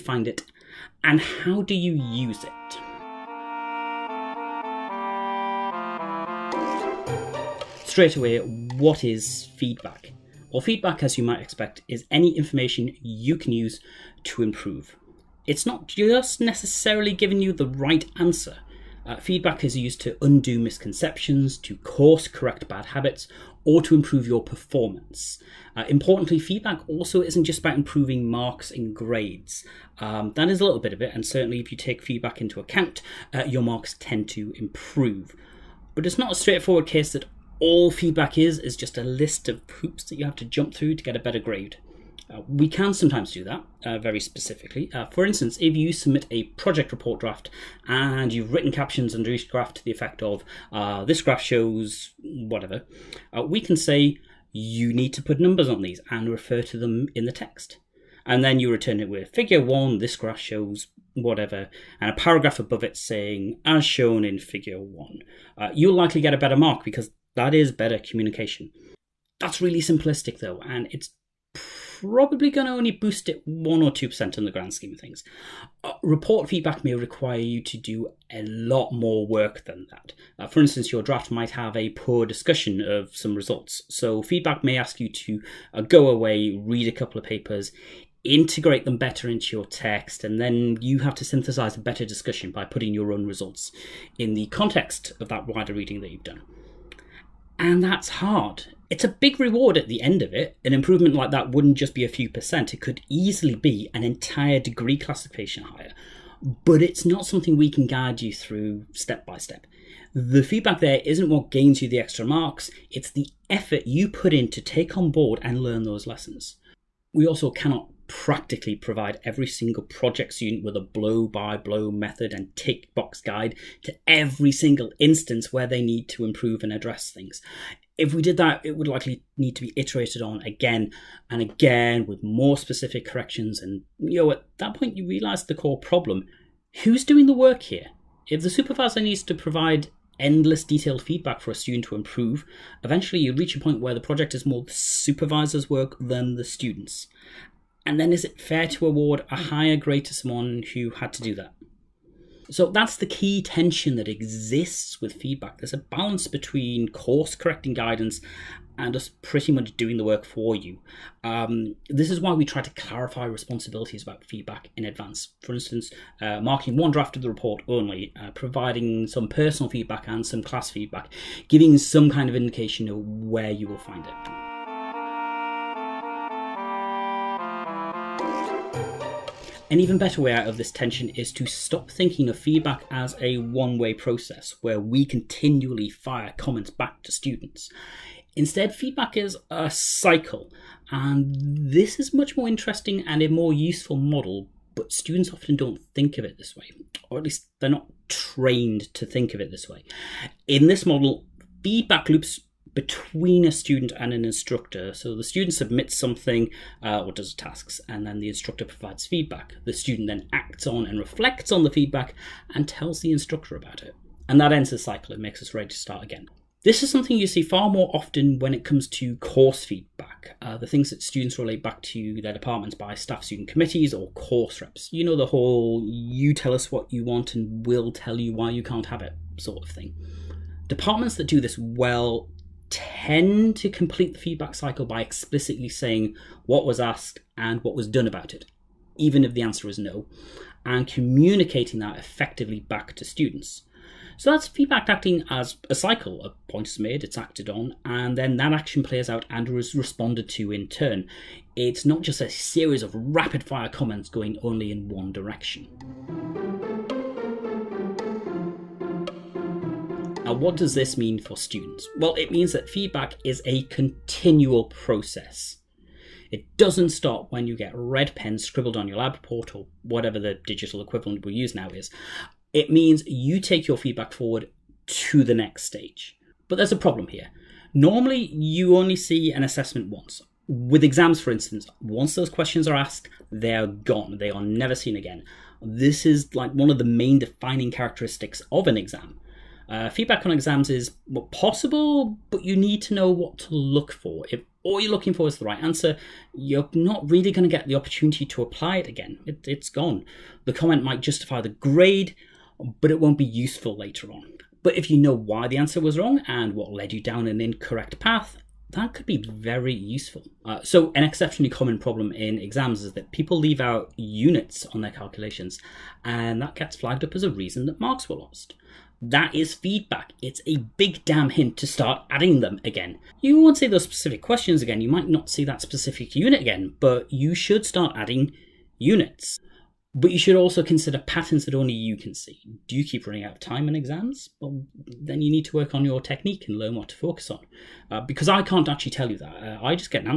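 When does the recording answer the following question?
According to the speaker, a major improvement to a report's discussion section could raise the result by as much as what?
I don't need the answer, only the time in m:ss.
1:43.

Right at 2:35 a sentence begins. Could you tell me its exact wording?
There's a balance between course correcting guidance and us pretty much doing the work for you.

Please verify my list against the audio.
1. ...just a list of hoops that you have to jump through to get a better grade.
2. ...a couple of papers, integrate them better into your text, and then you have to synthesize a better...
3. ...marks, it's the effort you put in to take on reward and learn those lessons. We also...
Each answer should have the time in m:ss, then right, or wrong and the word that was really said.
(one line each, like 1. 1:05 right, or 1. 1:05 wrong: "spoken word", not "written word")
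1. 0:38 right
2. 1:26 right
3. 1:52 wrong: "board", not "reward".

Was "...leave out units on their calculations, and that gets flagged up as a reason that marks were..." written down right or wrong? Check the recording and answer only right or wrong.
right.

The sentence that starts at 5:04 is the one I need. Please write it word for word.
But if you know why the answer was wrong and what led you down an incorrect path, that could be very useful.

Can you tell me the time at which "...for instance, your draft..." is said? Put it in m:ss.
1:20.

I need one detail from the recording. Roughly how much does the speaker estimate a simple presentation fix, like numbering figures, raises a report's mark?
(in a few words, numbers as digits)
1 or 2%.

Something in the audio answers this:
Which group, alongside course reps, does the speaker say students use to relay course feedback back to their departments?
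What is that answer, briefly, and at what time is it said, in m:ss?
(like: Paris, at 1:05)
staff student committees, at 3:42.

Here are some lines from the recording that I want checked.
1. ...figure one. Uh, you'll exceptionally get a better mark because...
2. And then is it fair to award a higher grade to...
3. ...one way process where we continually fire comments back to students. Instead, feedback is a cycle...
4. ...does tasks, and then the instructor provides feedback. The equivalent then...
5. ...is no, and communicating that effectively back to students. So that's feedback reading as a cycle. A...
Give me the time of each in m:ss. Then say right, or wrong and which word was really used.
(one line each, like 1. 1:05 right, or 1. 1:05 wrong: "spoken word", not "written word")
1. 1:04 wrong: "likely", not "exceptionally"
2. 2:27 right
3. 3:03 right
4. 3:27 wrong: "student", not "equivalent"
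5. 3:59 wrong: "acting", not "reading".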